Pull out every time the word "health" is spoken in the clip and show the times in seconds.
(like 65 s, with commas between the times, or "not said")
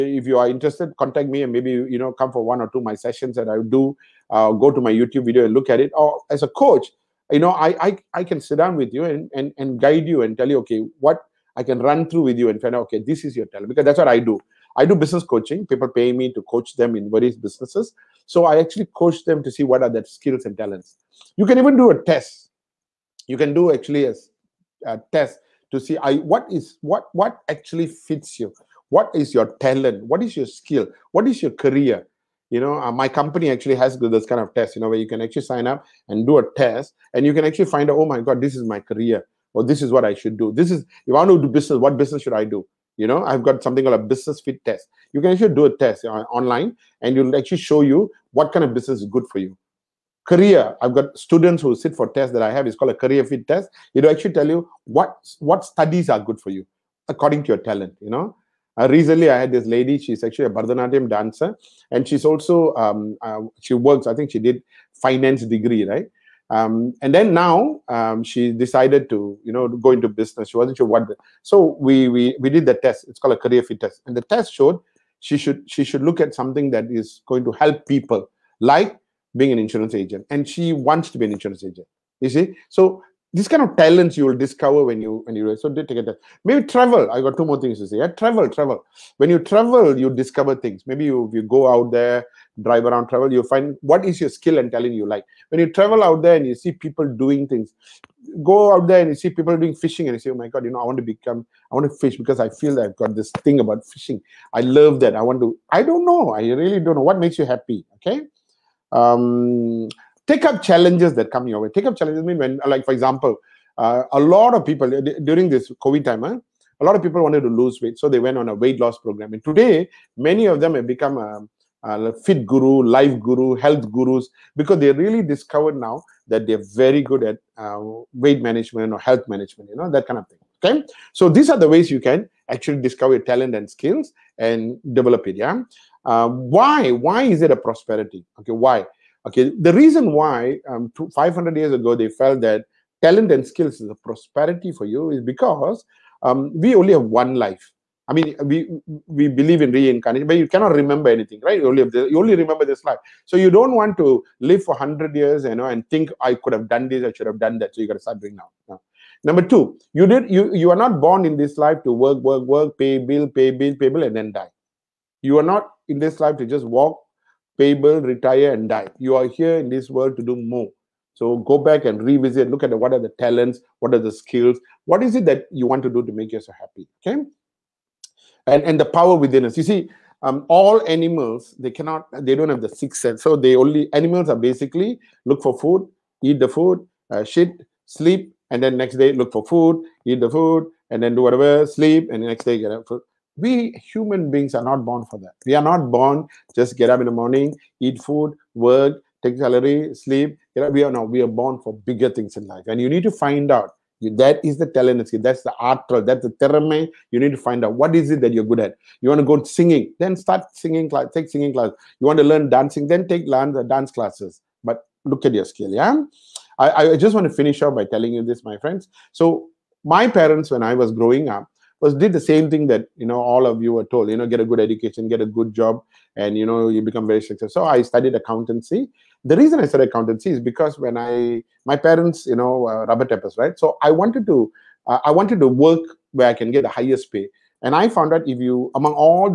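123 s, 128 s.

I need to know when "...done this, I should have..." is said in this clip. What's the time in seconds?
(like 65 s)
156 s.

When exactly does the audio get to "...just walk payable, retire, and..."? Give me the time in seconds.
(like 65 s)
166 s.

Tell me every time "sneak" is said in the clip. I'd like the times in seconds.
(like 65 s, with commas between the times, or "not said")
not said.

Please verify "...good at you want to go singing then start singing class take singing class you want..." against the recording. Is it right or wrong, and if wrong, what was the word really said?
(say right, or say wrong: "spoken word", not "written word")
right.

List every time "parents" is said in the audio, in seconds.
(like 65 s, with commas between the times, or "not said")
220 s, 231 s.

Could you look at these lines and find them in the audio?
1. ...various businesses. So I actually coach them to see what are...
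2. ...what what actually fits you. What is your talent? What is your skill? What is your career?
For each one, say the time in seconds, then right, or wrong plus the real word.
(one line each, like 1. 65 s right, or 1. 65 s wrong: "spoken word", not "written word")
1. 17 s right
2. 26 s right.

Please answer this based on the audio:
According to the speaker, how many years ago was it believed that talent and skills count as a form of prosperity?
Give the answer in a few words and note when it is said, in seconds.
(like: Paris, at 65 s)
500, at 141 s.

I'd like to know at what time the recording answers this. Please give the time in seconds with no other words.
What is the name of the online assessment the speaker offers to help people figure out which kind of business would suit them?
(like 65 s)
44 s.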